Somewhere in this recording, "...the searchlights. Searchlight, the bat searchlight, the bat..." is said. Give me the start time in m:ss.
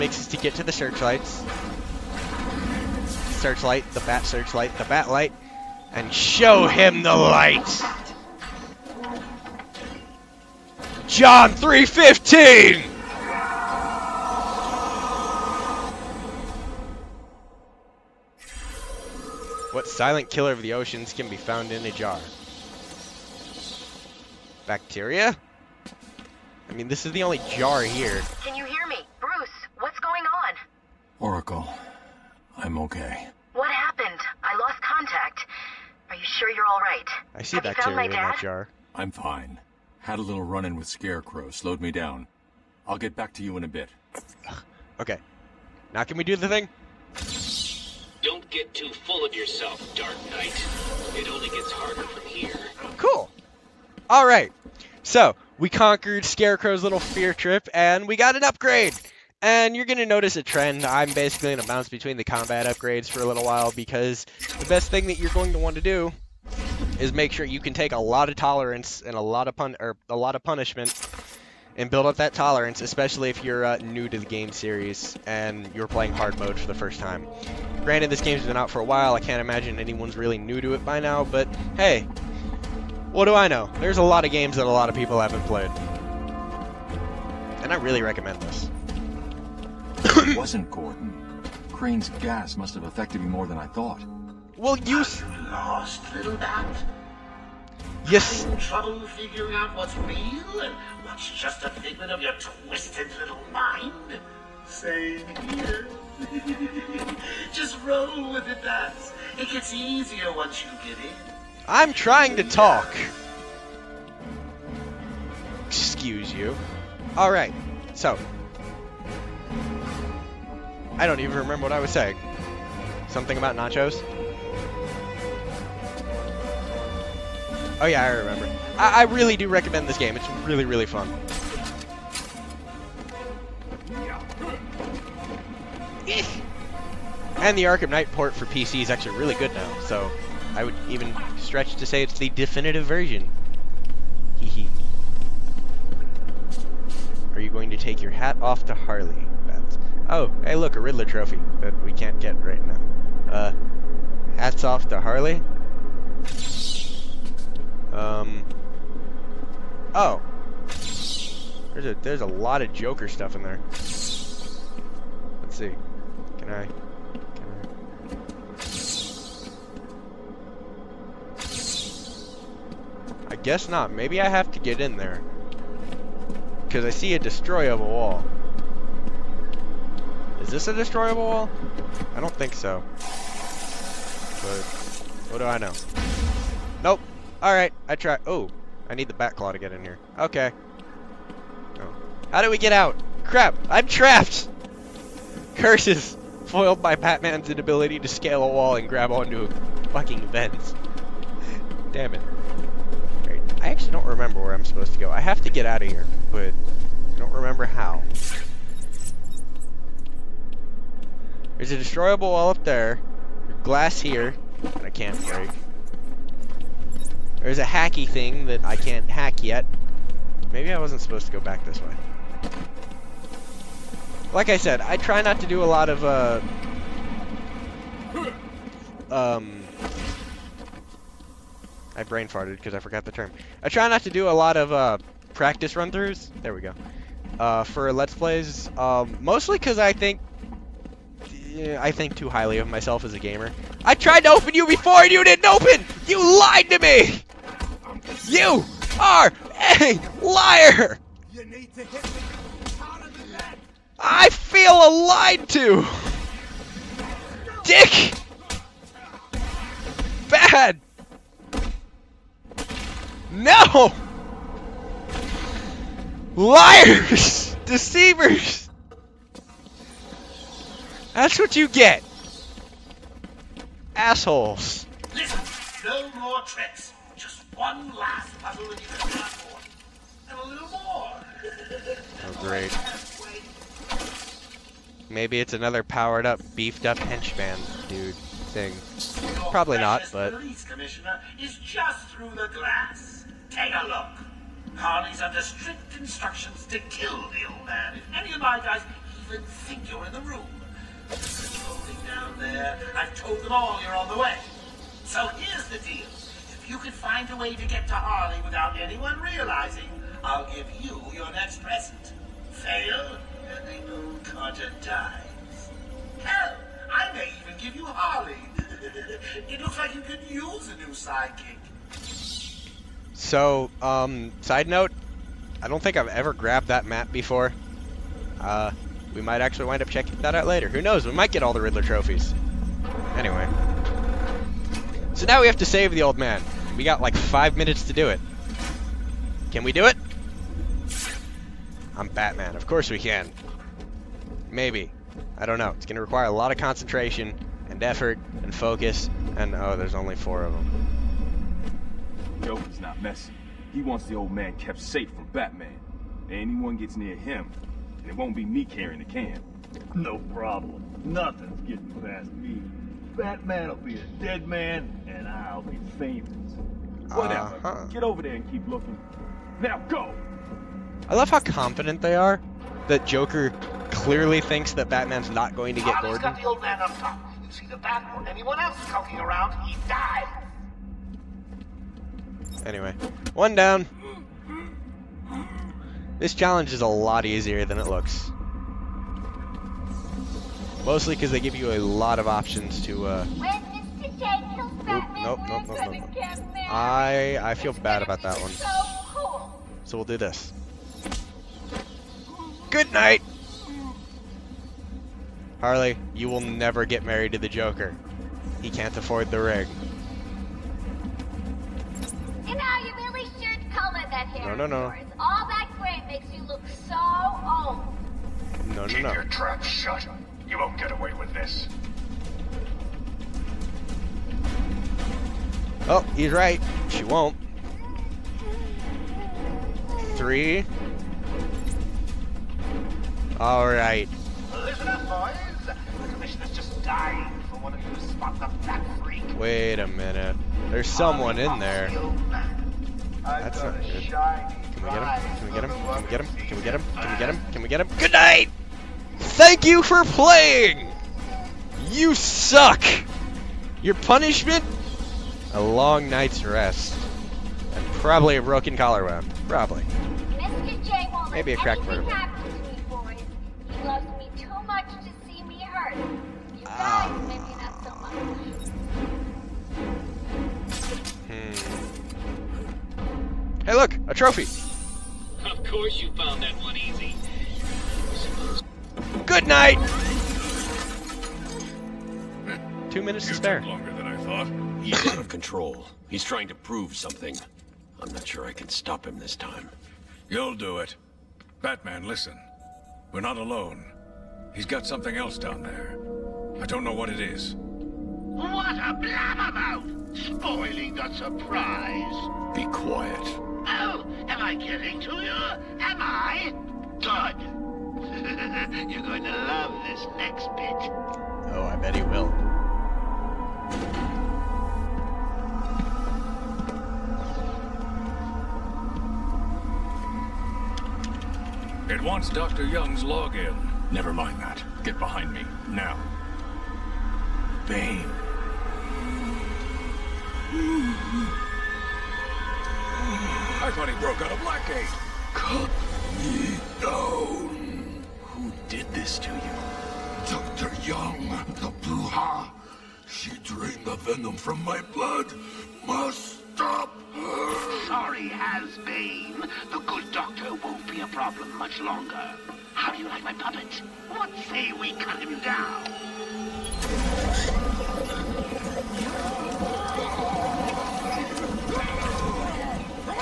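0:00.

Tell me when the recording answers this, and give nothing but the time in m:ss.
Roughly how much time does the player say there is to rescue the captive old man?
5:37.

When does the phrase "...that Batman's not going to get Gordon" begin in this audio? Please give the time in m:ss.
6:14.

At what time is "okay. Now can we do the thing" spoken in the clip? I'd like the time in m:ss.
0:44.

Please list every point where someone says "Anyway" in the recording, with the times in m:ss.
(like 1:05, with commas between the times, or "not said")
5:33, 6:22.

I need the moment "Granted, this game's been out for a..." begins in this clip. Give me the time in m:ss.
1:17.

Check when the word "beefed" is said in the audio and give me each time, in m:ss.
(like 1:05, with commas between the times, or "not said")
4:46.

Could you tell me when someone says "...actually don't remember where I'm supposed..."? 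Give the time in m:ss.
3:23.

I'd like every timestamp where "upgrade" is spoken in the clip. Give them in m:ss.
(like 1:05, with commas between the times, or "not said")
0:58, 1:02.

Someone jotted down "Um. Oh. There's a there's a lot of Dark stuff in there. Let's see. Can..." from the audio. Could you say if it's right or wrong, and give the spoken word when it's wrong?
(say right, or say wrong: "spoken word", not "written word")
wrong: "Joker", not "Dark".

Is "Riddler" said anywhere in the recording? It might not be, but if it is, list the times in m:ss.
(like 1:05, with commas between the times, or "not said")
2:30, 5:31.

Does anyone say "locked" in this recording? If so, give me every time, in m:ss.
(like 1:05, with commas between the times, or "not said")
not said.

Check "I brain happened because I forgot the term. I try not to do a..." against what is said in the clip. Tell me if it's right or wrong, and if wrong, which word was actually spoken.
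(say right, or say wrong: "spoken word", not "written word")
wrong: "farted", not "happened".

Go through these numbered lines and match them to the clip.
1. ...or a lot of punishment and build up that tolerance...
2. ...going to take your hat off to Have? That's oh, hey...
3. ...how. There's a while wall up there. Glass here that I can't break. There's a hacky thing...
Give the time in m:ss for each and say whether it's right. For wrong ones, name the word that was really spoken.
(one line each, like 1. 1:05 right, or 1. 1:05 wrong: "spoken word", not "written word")
1. 1:09 right
2. 2:27 wrong: "Harley", not "Have"
3. 3:27 wrong: "destroyable", not "while".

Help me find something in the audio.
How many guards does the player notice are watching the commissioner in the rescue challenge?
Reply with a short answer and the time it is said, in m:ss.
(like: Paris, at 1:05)
4, at 5:50.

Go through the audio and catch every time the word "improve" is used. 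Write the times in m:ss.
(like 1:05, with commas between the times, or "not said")
not said.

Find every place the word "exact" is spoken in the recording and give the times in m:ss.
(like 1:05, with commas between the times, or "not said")
not said.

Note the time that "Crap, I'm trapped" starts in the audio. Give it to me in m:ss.
3:13.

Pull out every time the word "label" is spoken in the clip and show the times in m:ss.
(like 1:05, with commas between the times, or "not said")
not said.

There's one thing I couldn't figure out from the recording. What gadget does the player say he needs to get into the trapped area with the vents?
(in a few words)
Batclaw.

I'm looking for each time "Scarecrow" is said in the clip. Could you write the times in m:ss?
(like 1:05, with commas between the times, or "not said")
0:40, 0:56.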